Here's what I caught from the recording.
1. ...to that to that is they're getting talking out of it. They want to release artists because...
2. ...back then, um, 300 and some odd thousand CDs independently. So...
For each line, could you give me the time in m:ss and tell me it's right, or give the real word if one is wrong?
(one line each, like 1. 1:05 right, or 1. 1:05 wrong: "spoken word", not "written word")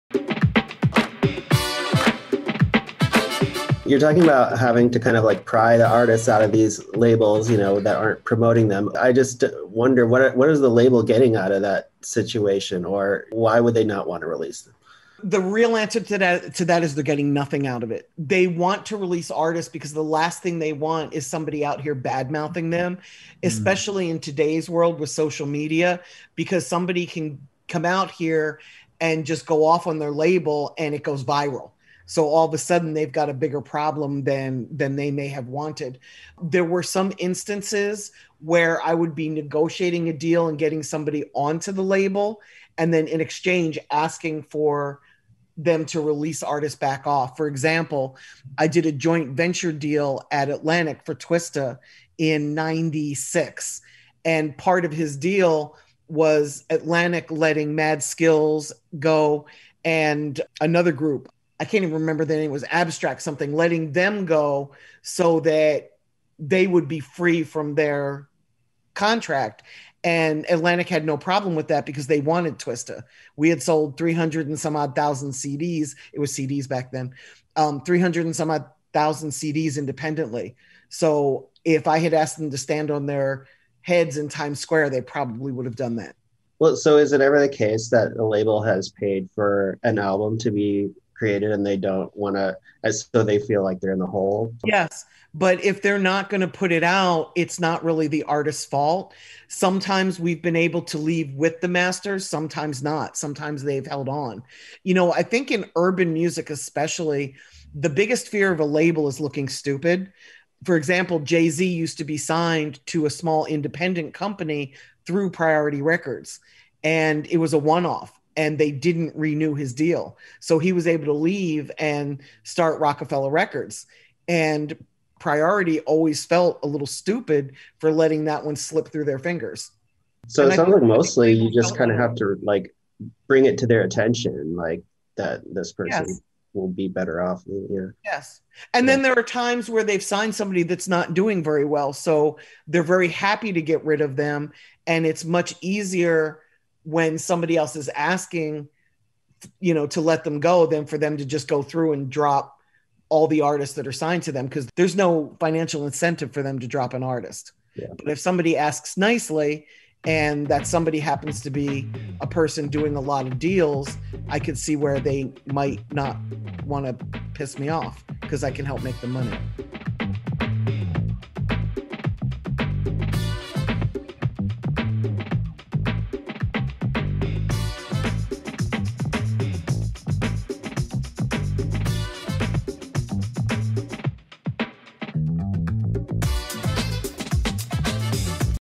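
1. 0:15 wrong: "nothing", not "talking"
2. 1:16 right.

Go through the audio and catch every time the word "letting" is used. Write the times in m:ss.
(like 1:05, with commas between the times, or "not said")
0:57, 1:03, 2:07.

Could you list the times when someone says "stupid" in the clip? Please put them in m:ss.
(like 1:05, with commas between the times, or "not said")
1:49, 2:06.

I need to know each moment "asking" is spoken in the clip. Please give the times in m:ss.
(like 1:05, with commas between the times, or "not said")
0:43, 2:27.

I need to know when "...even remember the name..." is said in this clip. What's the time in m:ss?
1:01.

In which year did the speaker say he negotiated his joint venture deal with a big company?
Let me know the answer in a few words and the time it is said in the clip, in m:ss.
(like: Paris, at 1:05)
1996, at 0:52.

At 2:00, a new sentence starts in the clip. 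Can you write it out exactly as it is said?
So he was able to leave and start Roc-A-Fella Records.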